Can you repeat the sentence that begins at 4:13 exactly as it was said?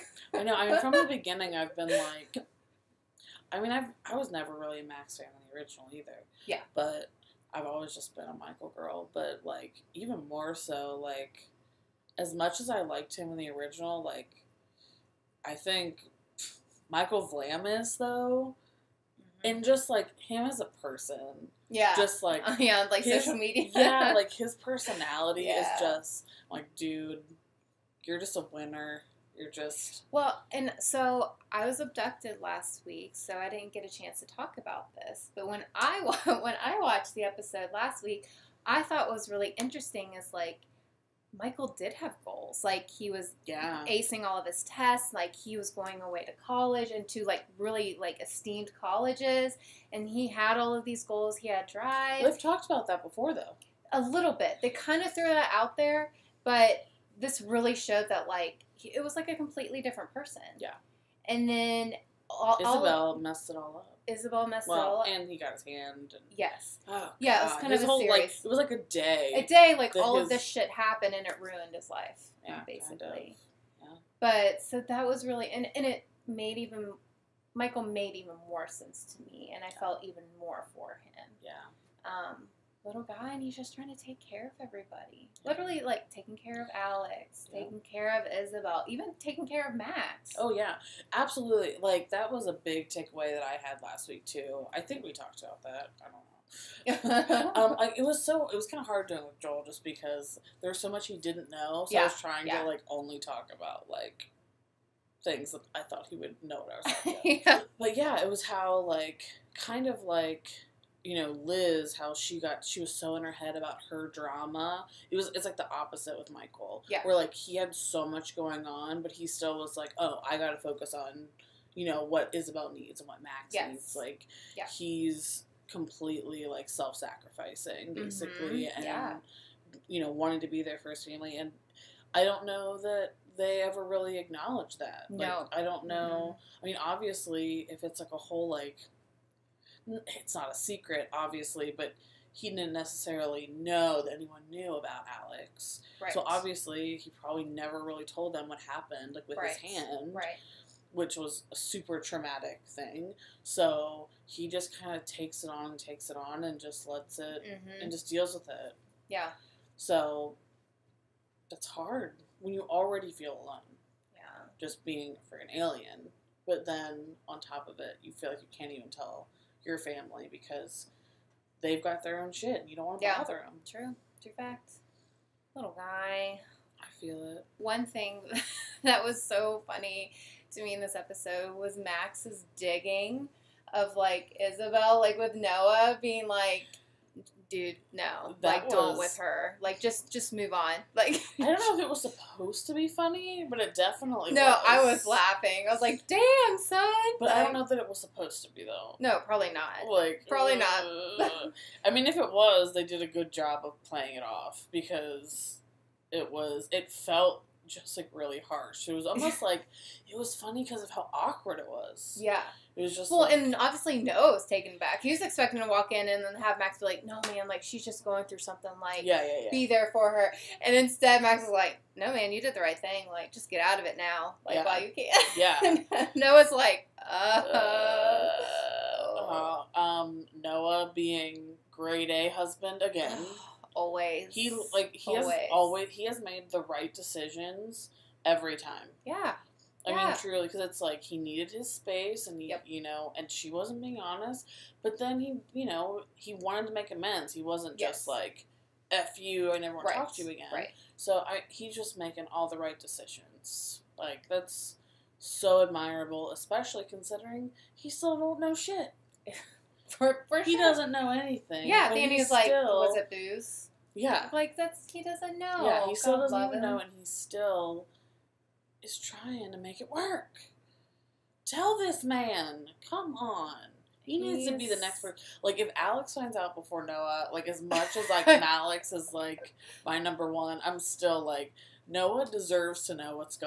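Like that's so admirable, especially considering he still don't know shit.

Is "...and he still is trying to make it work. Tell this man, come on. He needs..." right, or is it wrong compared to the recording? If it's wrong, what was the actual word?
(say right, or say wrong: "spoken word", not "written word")
right.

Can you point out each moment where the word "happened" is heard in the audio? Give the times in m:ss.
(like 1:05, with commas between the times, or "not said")
1:10, 2:28.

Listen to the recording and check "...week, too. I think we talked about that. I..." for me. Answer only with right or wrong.
right.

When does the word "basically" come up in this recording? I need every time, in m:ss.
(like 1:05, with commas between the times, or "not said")
1:12, 2:08.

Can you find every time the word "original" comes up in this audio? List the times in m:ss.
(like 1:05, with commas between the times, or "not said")
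0:05, 0:13.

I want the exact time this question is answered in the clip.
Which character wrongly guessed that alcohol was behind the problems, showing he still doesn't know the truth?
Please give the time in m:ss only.
4:21.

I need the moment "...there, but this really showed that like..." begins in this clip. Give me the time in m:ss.
0:55.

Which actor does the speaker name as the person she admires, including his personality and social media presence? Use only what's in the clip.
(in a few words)
Michael Vlamis.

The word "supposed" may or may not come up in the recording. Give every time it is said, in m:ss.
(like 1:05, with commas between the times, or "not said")
3:12, 3:18.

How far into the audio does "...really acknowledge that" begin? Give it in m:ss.
2:13.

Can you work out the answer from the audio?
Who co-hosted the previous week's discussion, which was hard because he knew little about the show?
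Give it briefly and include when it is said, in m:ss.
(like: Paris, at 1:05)
Joel, at 1:39.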